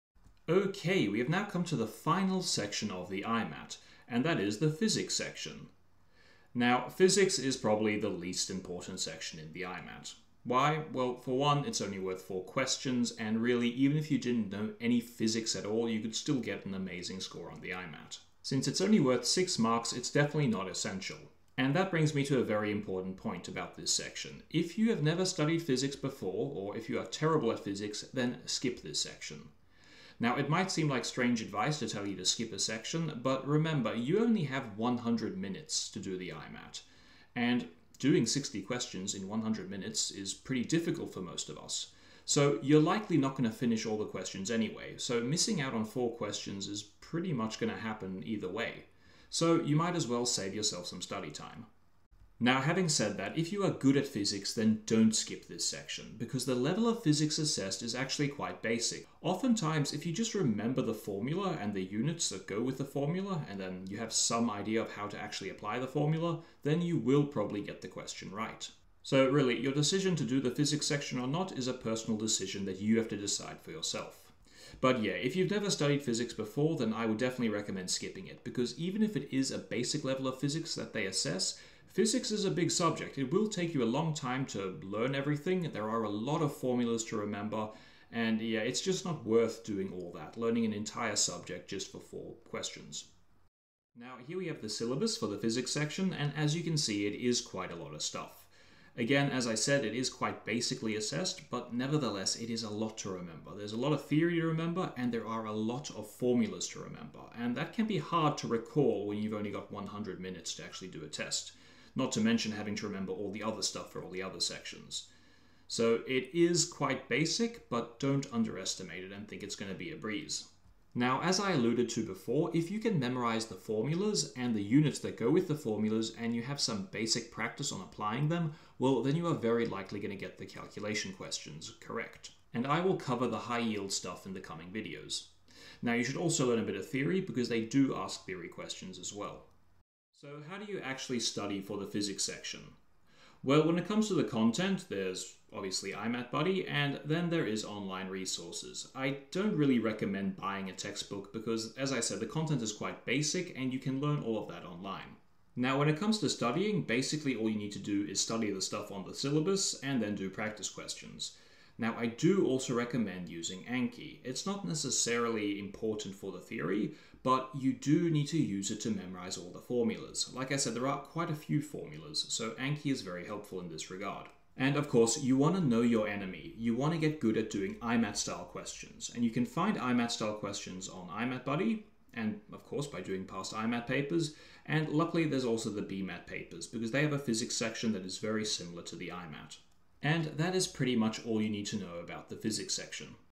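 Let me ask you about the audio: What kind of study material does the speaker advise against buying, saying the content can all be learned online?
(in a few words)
a textbook.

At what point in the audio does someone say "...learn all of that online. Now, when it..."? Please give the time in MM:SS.
02:33.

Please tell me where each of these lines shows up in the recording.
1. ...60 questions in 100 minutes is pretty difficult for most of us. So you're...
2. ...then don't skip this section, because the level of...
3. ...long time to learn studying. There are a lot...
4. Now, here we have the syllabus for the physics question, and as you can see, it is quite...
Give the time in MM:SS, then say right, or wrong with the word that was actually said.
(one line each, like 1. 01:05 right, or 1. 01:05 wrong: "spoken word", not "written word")
1. 00:38 right
2. 00:54 right
3. 01:23 wrong: "everything", not "studying"
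4. 01:33 wrong: "section", not "question".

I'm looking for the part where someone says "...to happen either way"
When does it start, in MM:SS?
00:47.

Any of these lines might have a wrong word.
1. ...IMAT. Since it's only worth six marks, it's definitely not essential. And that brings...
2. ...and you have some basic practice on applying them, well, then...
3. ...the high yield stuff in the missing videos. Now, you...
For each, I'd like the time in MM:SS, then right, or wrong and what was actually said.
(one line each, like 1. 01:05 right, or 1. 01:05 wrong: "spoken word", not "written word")
1. 00:17 right
2. 02:06 right
3. 02:13 wrong: "coming", not "missing".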